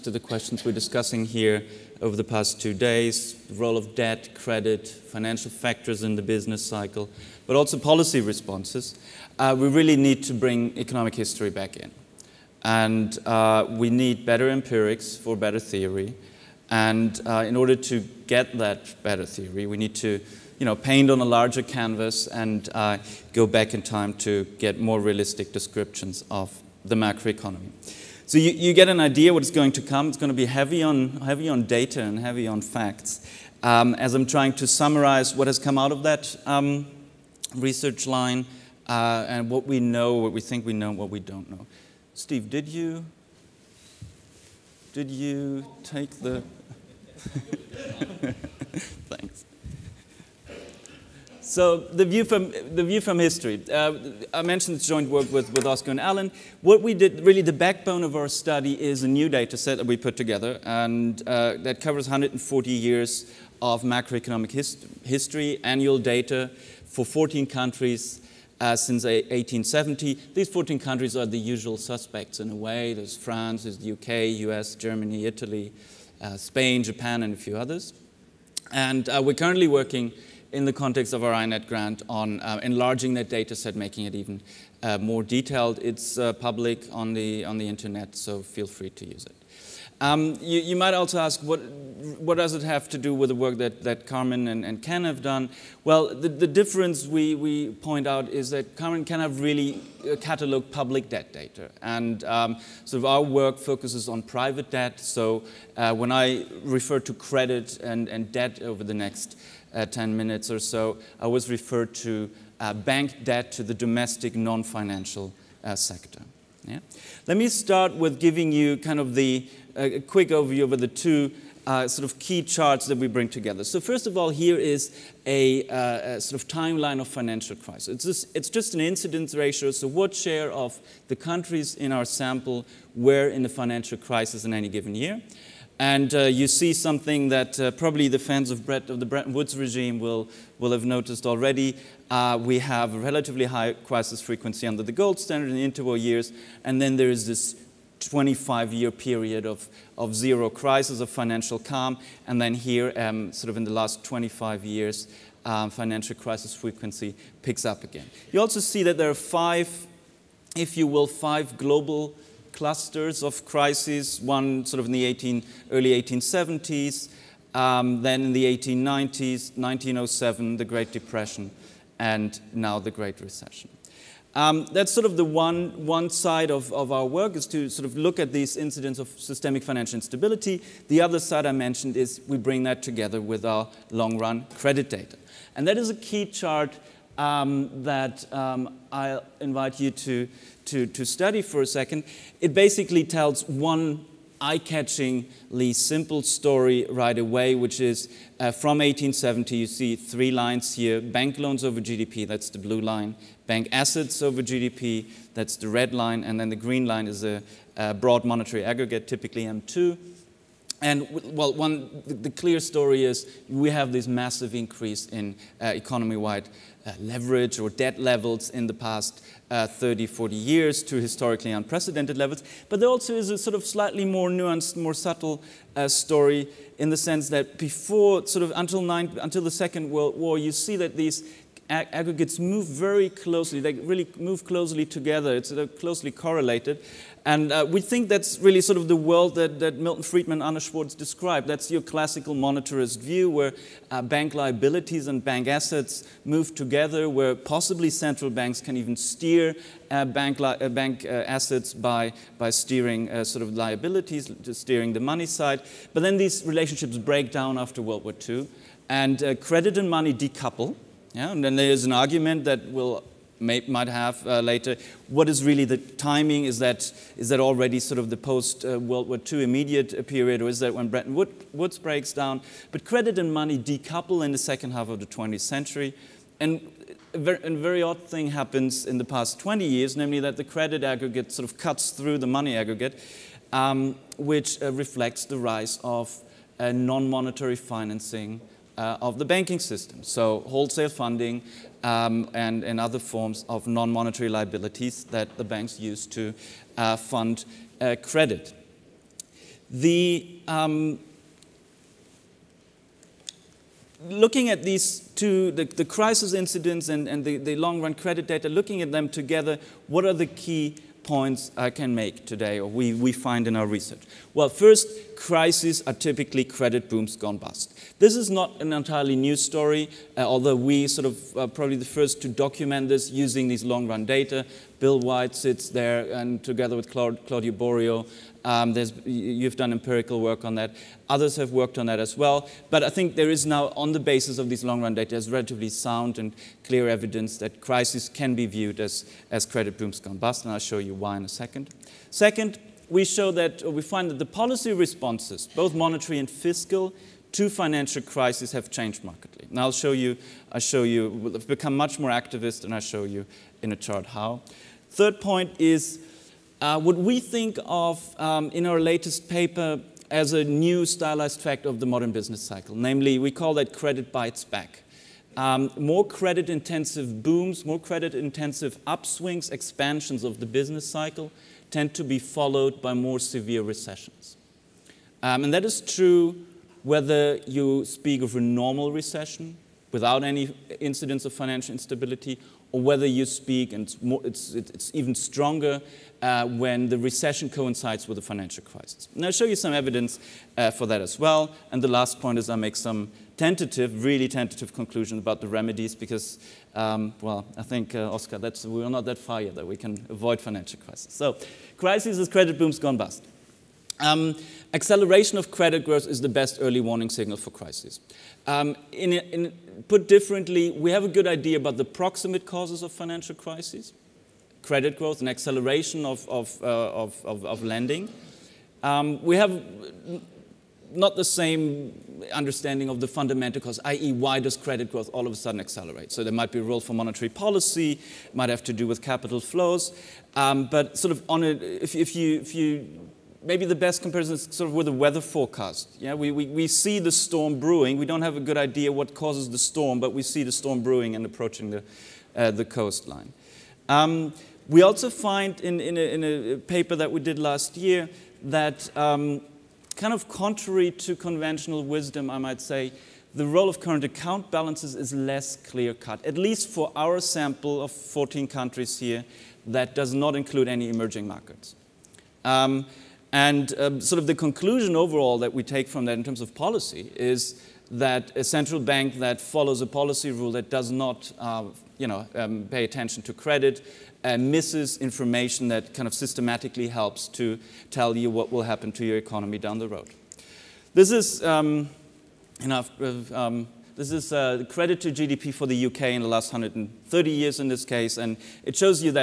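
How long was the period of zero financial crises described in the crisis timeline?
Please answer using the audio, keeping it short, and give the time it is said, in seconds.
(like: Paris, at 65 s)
25 years, at 147 s.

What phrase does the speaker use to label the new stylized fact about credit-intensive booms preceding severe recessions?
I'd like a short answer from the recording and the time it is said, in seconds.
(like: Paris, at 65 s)
Credit bites back, at 363 s.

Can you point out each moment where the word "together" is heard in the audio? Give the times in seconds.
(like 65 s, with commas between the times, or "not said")
60 s, 123 s, 182 s, 234 s, 246 s, 309 s, 326 s.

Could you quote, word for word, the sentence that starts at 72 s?
There's France, there's the UK, US, Germany, Italy, uh, Spain, Japan, and a few others.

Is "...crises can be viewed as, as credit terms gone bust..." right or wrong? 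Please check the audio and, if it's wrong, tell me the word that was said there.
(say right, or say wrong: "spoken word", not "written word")
wrong: "booms", not "terms".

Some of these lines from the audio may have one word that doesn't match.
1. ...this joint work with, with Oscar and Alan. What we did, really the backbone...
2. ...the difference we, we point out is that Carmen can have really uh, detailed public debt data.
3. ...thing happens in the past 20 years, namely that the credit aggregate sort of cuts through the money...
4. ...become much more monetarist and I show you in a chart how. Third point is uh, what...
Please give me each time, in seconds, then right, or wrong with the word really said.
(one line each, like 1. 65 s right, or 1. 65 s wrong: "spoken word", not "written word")
1. 54 s right
2. 96 s wrong: "cataloged", not "detailed"
3. 278 s right
4. 351 s wrong: "activist", not "monetarist".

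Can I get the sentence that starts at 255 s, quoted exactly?
But then these relationships break down after World War II, and credit and money decouple.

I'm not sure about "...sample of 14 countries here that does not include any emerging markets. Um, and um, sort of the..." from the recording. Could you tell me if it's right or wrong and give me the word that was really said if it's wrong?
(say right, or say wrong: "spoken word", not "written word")
right.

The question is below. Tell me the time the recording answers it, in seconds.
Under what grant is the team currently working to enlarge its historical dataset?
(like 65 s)
81 s.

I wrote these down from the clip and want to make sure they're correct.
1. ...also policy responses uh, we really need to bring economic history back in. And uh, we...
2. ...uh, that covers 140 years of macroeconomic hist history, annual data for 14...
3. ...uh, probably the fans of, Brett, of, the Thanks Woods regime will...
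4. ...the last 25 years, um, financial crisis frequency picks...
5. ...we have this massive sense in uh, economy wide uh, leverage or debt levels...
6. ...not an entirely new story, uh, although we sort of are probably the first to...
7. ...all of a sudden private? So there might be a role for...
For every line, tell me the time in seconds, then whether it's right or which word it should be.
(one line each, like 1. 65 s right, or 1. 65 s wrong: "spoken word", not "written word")
1. 7 s right
2. 61 s right
3. 137 s wrong: "Bretton", not "Thanks"
4. 153 s right
5. 213 s wrong: "increase", not "sense"
6. 318 s right
7. 425 s wrong: "accelerate", not "private".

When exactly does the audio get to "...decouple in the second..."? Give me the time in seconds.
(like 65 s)
273 s.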